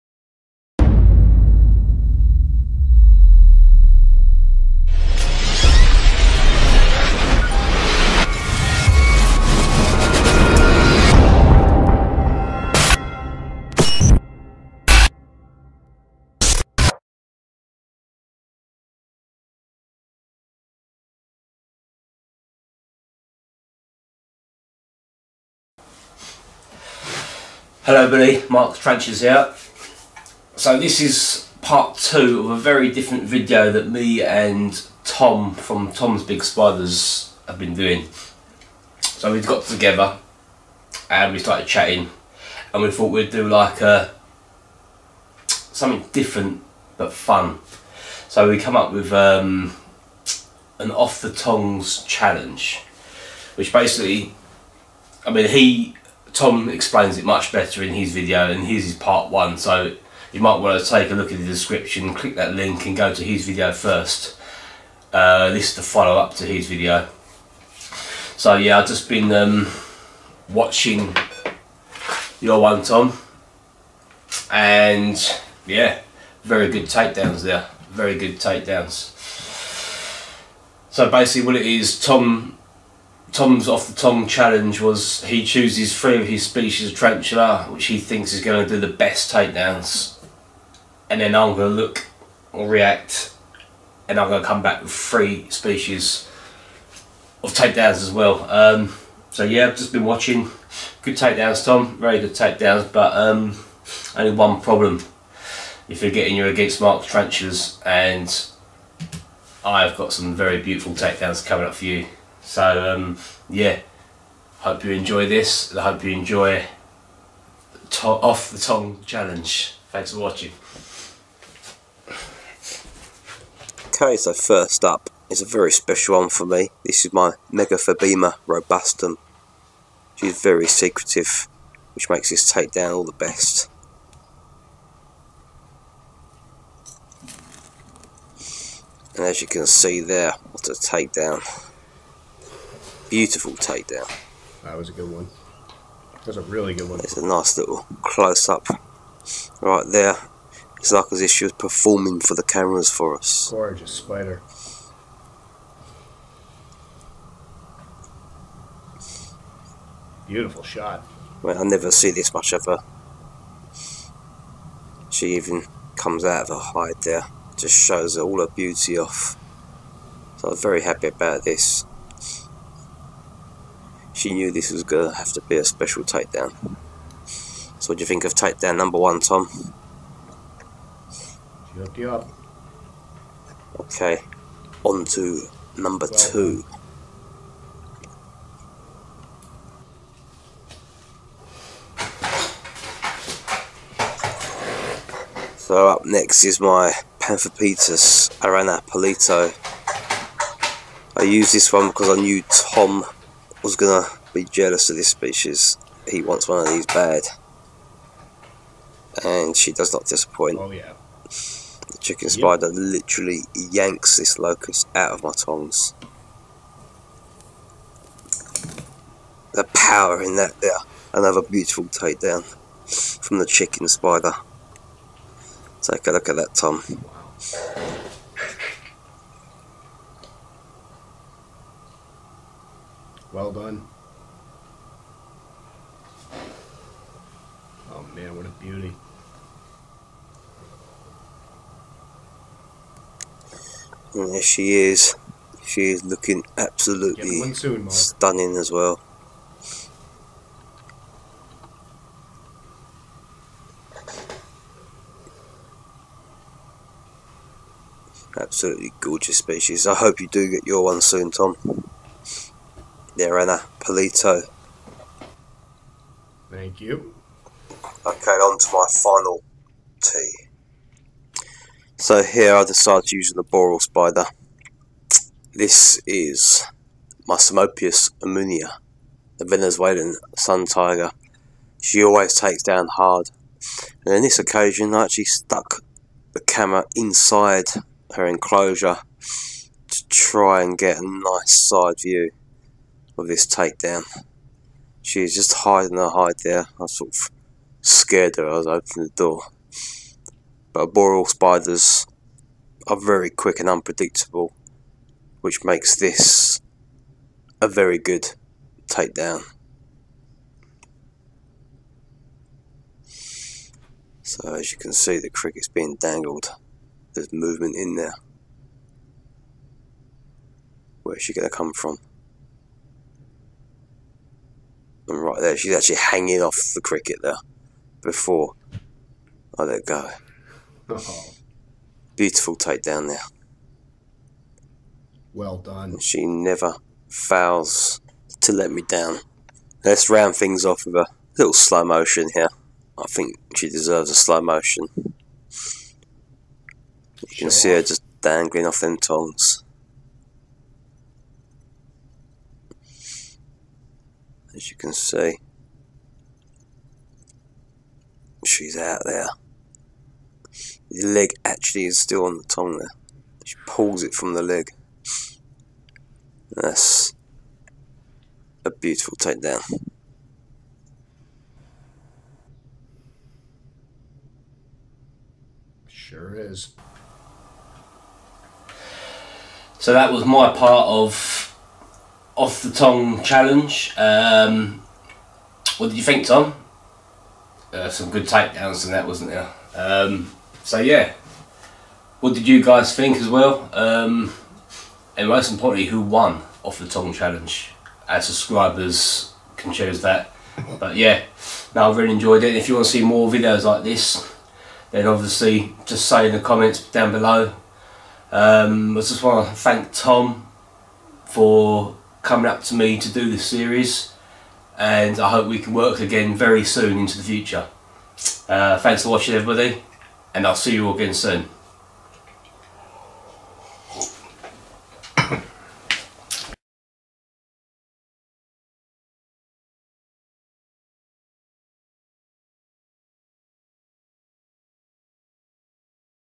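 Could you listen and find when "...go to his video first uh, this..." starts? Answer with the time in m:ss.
1:02.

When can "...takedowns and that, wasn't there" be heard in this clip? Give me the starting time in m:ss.
6:28.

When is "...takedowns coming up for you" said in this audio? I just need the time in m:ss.
1:50.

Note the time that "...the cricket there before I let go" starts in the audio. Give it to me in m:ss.
5:26.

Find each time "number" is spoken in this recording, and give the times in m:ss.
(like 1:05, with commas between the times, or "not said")
2:58, 3:05.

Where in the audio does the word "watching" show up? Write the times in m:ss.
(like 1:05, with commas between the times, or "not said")
1:10, 1:40, 2:00, 6:59.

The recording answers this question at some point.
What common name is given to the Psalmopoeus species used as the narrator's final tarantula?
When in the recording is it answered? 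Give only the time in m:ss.
4:39.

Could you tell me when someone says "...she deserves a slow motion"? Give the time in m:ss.
5:43.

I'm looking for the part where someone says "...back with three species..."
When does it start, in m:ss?
1:34.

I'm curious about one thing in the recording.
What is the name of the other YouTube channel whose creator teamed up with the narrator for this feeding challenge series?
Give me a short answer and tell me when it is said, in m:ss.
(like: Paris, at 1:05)
Tom's Big Spiders, at 0:35.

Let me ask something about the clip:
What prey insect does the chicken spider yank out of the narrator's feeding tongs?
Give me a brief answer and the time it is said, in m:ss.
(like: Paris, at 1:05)
locust, at 3:34.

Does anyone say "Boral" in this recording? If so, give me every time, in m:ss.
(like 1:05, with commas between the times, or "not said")
4:33.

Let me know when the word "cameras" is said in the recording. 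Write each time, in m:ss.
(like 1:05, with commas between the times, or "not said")
2:32, 4:46.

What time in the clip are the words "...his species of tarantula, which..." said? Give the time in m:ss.
1:26.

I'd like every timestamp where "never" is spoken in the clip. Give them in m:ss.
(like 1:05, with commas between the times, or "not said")
2:41, 5:36.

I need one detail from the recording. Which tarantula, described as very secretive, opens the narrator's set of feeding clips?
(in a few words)
Megaphobema robustum.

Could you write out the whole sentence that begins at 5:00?
But boreal spiders are very quick and unpredictable, which makes this a very good takedown.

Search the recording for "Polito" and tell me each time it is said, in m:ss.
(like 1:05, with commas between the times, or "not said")
3:18, 4:23.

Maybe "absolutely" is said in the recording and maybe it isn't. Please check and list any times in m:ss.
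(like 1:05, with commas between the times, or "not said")
4:06, 4:18.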